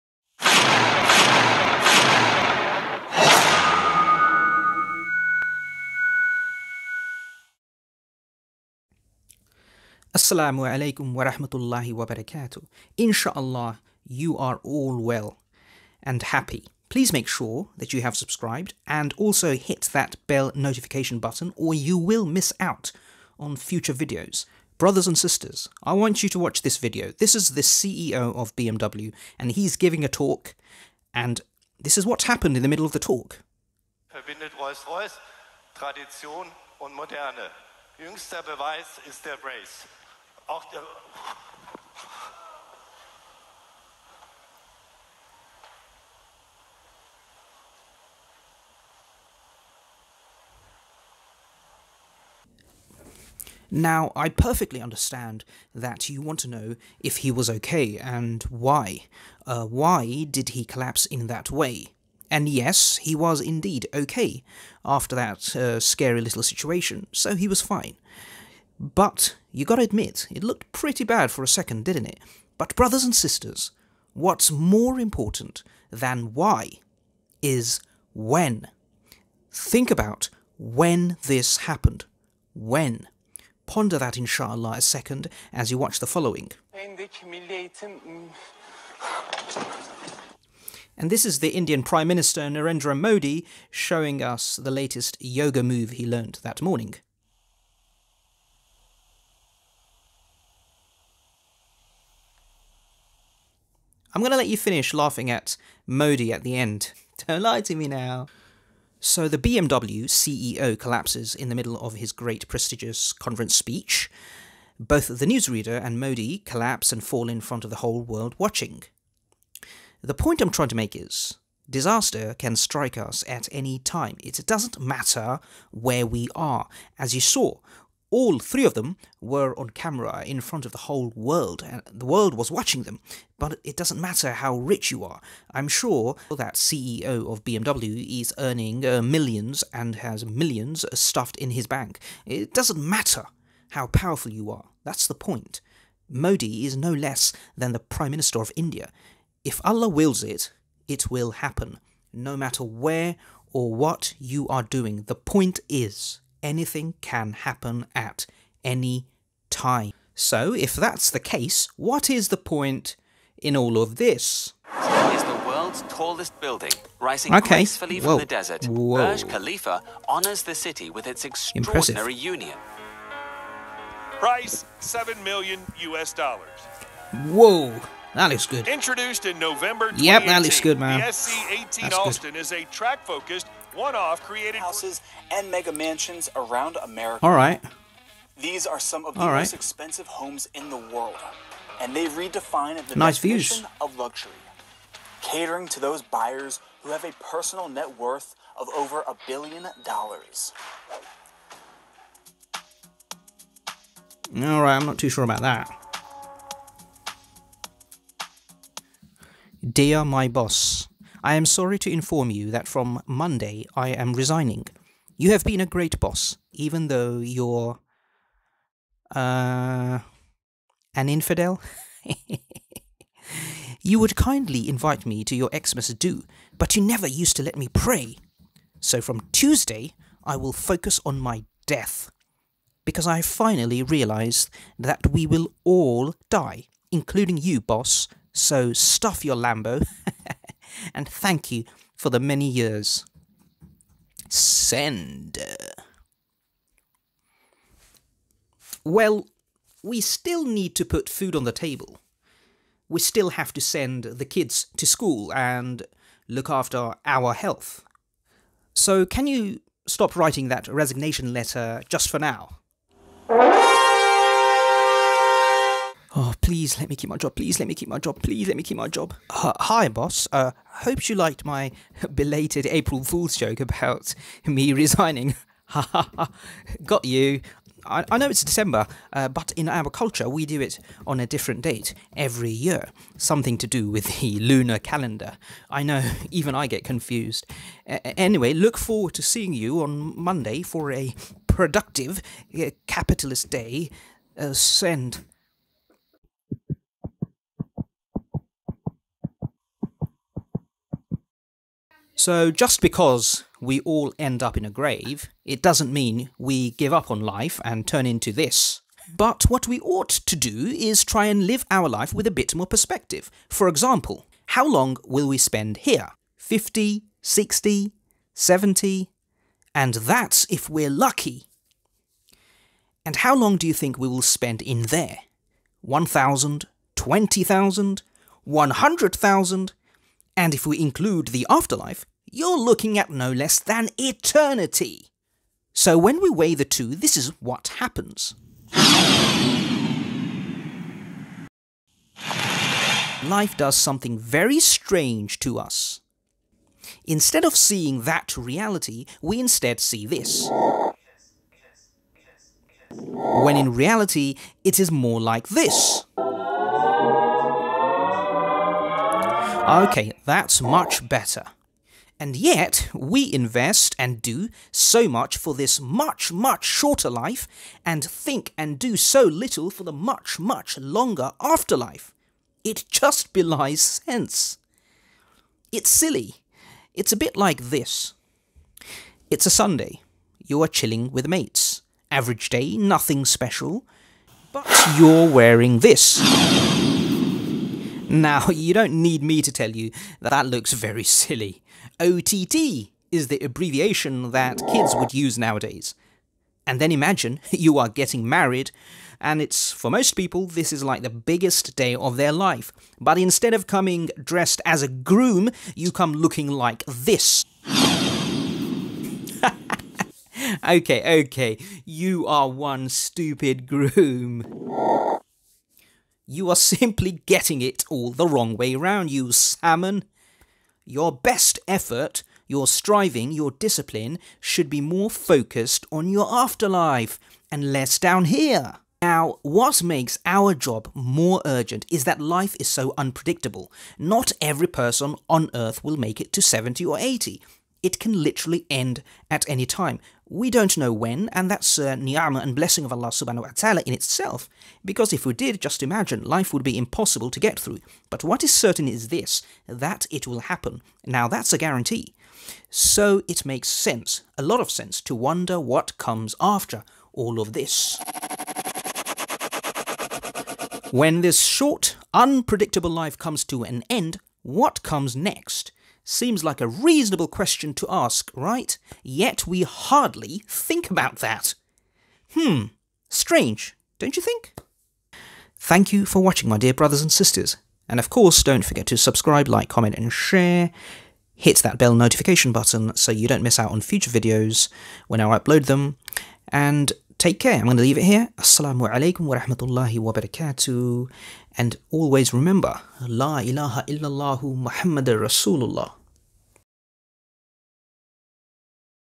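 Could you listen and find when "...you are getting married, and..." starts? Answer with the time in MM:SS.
06:37.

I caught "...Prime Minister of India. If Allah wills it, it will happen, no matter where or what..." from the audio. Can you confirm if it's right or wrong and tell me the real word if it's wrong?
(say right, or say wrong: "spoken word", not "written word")
right.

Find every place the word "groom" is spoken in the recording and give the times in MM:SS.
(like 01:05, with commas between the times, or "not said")
06:44, 06:53.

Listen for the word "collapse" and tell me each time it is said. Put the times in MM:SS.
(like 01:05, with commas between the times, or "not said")
01:00, 01:50, 01:56.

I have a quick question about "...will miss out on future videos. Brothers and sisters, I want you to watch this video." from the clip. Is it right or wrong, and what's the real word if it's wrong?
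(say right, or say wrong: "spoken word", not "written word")
right.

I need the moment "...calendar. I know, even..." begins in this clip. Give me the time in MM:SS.
04:44.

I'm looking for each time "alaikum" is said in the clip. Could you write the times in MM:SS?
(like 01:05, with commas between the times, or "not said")
00:10, 08:08.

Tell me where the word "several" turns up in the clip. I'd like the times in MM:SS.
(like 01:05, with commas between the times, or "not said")
not said.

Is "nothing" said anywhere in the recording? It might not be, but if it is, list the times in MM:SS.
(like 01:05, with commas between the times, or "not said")
06:22.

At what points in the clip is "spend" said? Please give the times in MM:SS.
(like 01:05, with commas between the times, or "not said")
05:15, 05:24.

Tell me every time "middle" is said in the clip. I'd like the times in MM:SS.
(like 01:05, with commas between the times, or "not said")
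00:32, 01:51.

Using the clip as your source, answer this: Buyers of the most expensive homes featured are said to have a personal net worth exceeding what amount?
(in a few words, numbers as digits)
a billion dollars.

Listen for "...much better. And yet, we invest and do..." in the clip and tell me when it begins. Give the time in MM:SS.
06:00.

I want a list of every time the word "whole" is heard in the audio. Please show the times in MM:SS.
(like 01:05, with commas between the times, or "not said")
01:57, 02:10.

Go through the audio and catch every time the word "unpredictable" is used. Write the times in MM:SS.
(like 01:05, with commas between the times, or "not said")
07:12, 07:42.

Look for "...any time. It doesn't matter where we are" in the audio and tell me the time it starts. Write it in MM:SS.
02:03.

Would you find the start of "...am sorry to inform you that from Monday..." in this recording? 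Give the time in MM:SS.
03:31.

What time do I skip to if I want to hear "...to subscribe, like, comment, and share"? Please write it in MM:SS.
07:58.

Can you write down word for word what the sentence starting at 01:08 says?
But you gotta admit, it looked pretty bad for a second, didn't it?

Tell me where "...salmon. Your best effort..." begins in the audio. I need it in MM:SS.
06:59.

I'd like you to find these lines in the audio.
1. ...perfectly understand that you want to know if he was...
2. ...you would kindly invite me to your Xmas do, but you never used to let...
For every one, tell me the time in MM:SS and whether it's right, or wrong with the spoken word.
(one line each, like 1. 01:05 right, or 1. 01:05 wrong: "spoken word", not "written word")
1. 00:54 right
2. 03:43 right.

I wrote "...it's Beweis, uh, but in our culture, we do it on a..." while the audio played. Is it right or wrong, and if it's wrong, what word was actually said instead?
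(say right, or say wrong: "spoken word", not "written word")
wrong: "December", not "Beweis".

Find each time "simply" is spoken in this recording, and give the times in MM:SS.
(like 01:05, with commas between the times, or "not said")
06:56.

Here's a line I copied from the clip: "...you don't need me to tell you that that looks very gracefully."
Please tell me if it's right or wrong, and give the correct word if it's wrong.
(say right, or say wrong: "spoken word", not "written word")
wrong: "silly", not "gracefully".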